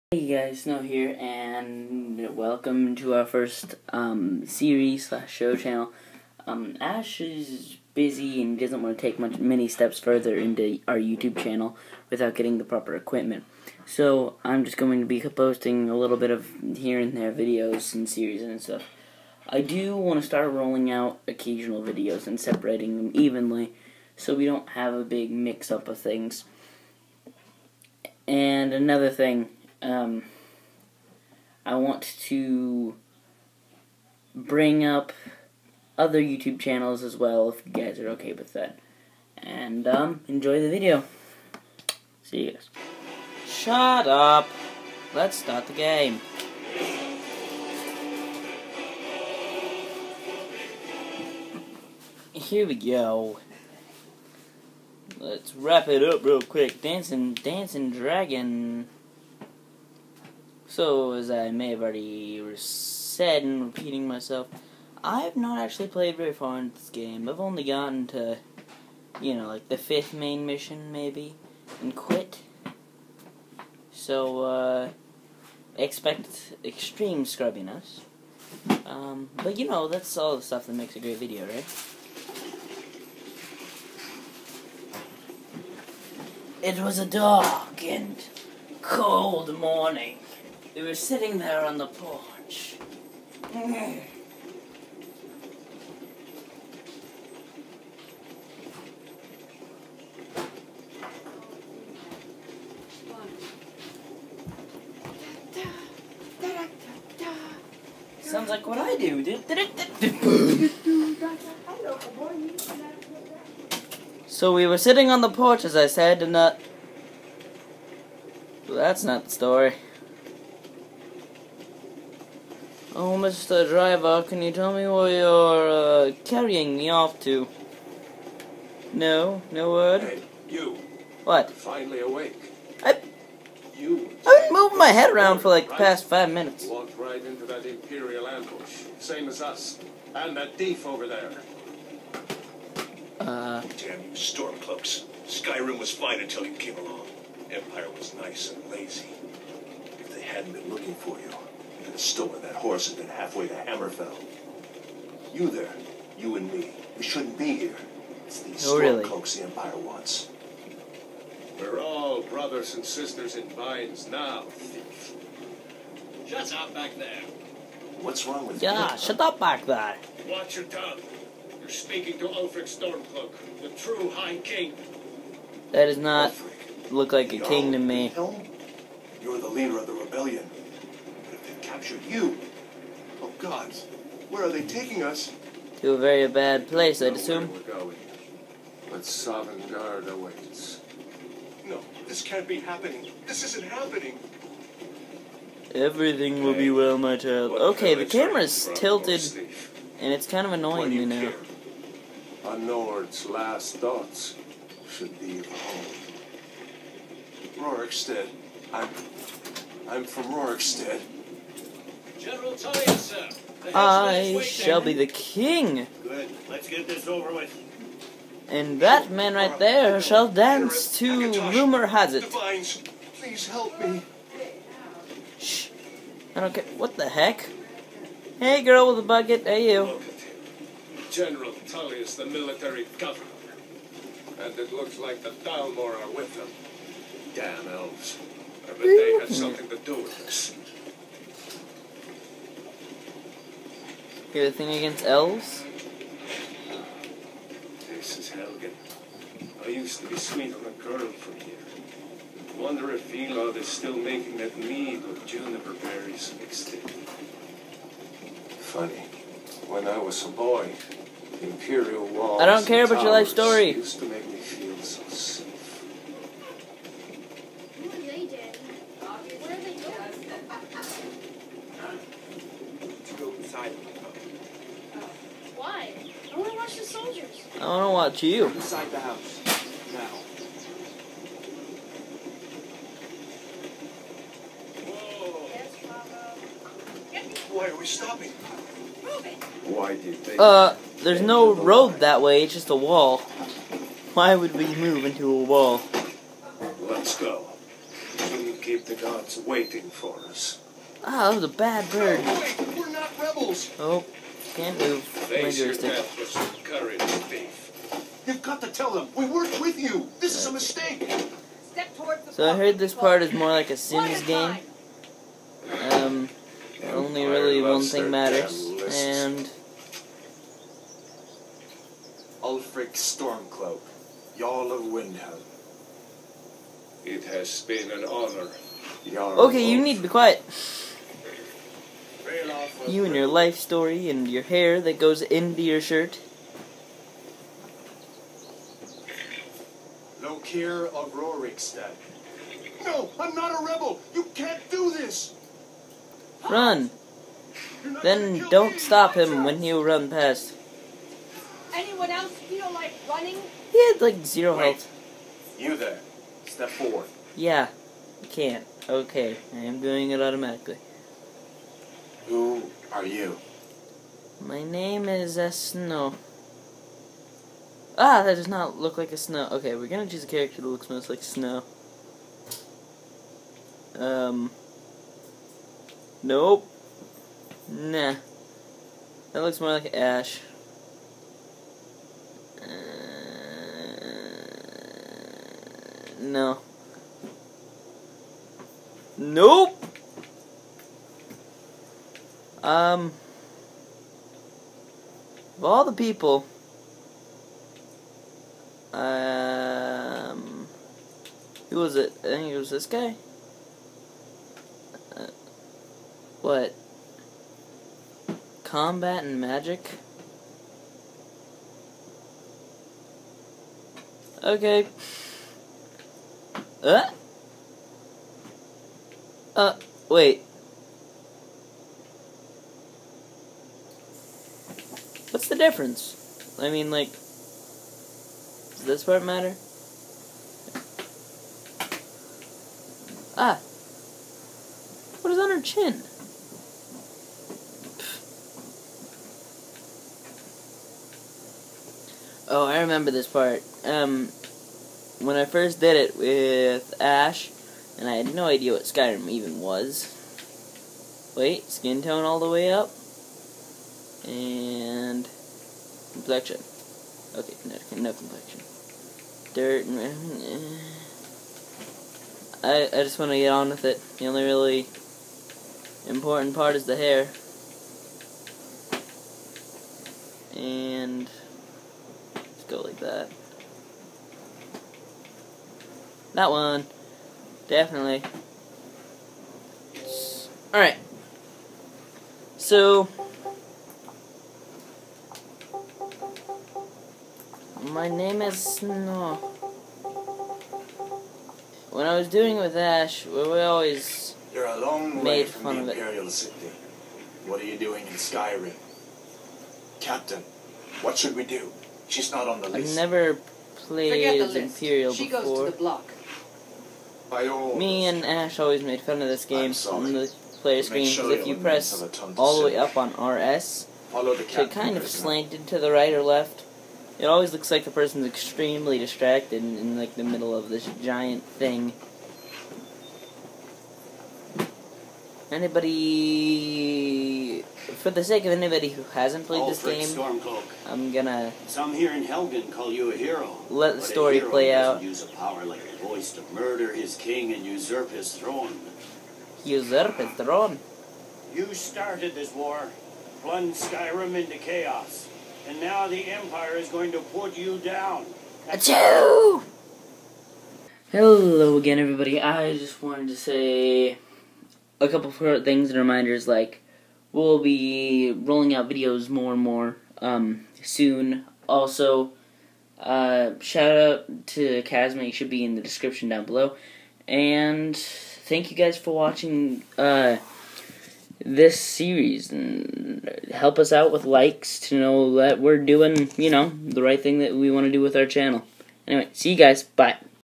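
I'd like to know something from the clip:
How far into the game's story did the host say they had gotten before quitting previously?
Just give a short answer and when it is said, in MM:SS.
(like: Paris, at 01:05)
Fifth main mission, at 01:09.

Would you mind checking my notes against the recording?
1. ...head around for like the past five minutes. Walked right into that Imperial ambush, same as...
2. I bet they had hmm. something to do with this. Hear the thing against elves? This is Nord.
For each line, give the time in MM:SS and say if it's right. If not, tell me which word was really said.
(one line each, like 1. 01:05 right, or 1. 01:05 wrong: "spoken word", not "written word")
1. 02:14 right
2. 03:58 wrong: "Helgen", not "Nord".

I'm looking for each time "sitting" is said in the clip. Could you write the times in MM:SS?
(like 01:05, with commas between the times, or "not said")
01:30, 01:54.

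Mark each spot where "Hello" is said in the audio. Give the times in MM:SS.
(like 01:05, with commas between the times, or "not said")
09:11.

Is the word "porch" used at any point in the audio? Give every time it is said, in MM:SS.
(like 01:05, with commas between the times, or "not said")
01:31, 01:55.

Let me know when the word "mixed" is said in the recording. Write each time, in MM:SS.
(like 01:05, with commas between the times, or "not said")
04:16.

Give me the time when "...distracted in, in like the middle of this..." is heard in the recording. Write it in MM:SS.
08:38.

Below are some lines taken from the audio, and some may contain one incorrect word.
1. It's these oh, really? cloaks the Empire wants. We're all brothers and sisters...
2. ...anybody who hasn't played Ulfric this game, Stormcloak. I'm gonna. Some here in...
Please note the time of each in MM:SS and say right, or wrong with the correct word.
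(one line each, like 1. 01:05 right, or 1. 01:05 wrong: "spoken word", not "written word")
1. 02:38 right
2. 08:48 right.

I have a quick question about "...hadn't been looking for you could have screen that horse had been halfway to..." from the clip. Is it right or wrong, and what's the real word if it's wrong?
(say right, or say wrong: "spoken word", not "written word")
wrong: "stolen", not "screen".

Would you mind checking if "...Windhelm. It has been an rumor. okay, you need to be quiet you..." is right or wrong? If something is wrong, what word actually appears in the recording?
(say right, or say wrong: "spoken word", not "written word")
wrong: "honor", not "rumor".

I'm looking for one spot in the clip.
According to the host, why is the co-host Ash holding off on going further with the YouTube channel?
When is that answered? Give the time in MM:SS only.
00:12.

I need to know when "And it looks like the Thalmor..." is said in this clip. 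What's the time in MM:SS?
03:54.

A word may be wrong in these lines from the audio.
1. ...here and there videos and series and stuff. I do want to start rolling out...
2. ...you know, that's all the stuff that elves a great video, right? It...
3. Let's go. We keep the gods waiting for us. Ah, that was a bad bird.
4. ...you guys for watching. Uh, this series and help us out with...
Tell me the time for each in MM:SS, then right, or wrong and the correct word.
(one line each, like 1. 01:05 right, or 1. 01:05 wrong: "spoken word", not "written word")
1. 00:16 right
2. 01:19 wrong: "makes", not "elves"
3. 04:56 right
4. 09:28 right.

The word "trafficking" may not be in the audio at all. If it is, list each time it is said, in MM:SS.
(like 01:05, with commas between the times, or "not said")
not said.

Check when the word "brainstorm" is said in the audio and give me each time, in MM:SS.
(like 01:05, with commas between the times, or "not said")
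not said.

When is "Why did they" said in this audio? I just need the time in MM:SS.
04:48.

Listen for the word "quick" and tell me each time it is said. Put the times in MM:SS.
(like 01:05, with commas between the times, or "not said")
00:56.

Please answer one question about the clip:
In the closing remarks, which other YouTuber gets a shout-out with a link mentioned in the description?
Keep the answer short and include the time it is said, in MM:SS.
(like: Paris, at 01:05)
Kazma, at 09:24.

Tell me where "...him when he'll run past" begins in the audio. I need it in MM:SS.
05:49.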